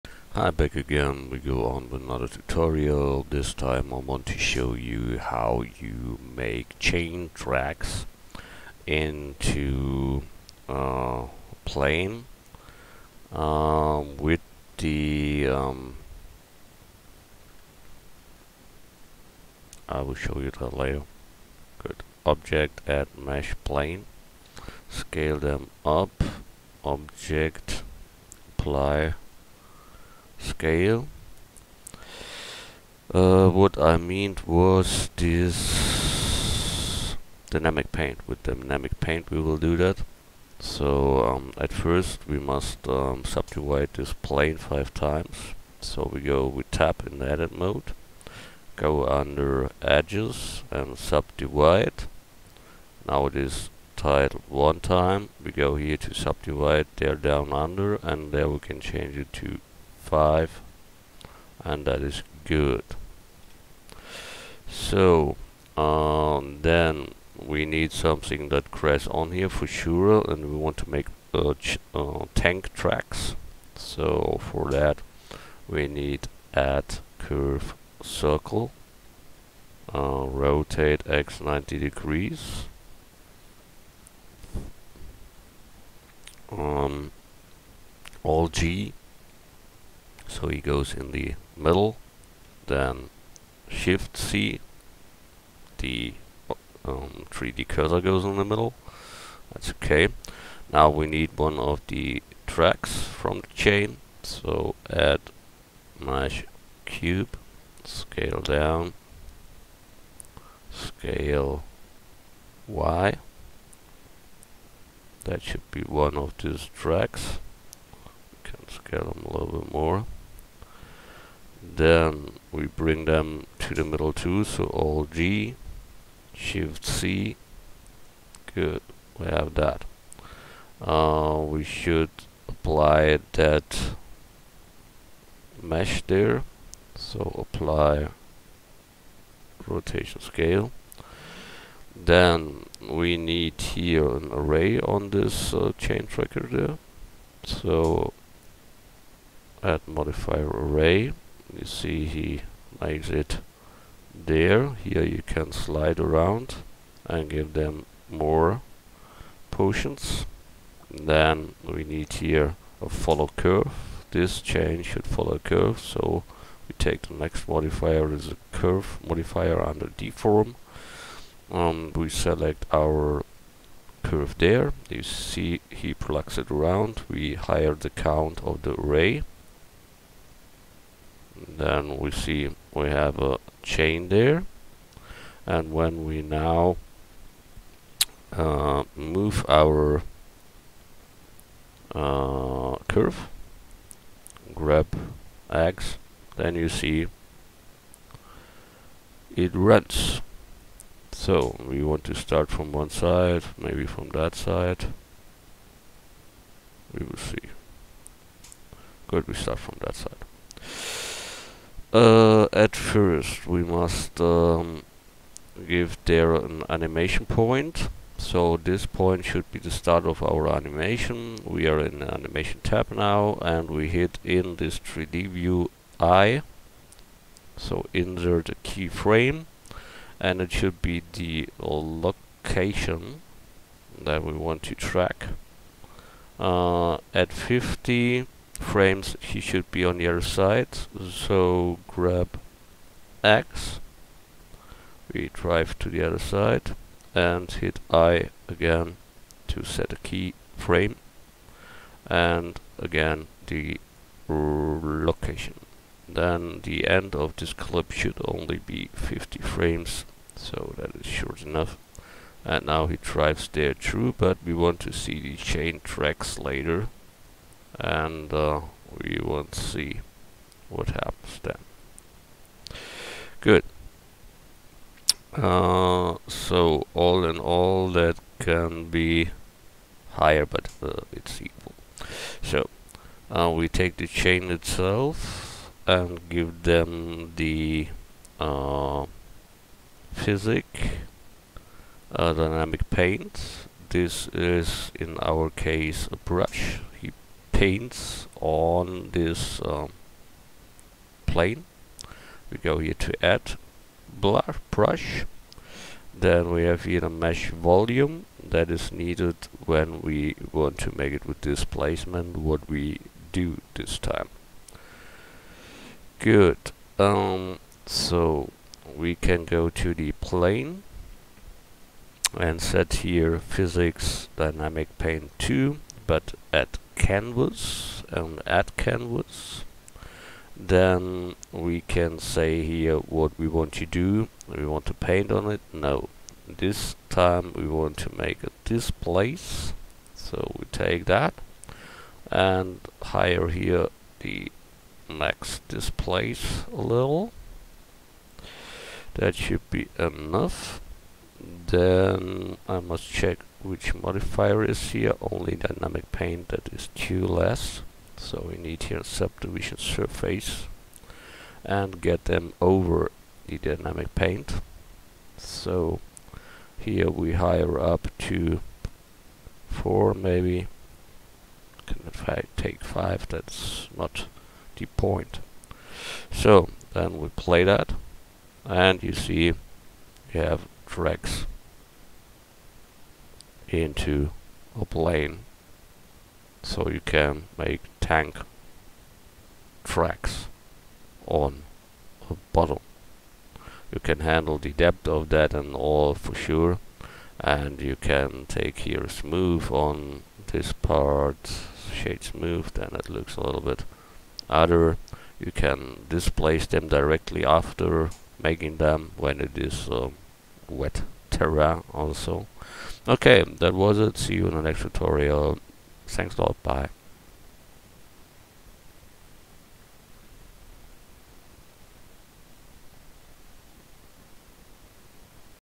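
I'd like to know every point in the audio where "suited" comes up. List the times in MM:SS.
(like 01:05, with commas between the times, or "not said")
not said.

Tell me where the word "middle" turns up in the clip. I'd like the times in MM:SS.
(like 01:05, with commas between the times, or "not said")
01:31, 01:38, 02:03.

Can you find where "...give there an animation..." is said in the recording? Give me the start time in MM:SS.
03:35.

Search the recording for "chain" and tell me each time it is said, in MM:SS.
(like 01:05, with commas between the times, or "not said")
00:06, 01:43, 02:25, 02:44, 03:03, 04:25, 04:44.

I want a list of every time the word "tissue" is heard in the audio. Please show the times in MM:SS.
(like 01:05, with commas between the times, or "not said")
not said.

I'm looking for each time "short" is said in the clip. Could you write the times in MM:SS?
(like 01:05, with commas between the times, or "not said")
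04:21.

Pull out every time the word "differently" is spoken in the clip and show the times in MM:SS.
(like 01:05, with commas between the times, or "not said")
not said.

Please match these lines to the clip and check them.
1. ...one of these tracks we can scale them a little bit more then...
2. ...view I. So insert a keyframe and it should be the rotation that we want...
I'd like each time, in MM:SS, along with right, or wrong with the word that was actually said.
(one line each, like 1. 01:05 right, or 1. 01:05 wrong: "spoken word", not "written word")
1. 01:55 right
2. 03:45 wrong: "location", not "rotation".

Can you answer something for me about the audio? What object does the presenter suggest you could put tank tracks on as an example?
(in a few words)
a bottle.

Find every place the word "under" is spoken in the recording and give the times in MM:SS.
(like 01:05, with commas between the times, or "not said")
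00:49, 00:57, 02:49.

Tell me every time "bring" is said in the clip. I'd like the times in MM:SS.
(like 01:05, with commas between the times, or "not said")
02:02.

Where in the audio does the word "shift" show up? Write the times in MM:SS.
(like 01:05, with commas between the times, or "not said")
01:33, 02:06.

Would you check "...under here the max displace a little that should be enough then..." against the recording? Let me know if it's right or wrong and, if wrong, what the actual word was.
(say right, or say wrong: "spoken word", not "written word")
wrong: "higher", not "under".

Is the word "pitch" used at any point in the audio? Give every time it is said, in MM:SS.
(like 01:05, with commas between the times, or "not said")
not said.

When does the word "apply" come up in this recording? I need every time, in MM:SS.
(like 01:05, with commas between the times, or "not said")
00:28, 02:12, 02:17.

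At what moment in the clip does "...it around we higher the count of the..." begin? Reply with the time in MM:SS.
02:56.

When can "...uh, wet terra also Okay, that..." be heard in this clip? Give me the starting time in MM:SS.
06:49.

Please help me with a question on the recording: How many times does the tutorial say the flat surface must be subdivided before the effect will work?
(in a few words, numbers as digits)
5.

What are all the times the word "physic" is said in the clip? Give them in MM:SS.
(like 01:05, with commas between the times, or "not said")
04:50, 05:23.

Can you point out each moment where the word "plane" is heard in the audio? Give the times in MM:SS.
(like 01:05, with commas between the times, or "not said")
00:11, 00:23, 00:44, 05:01, 05:20, 06:24.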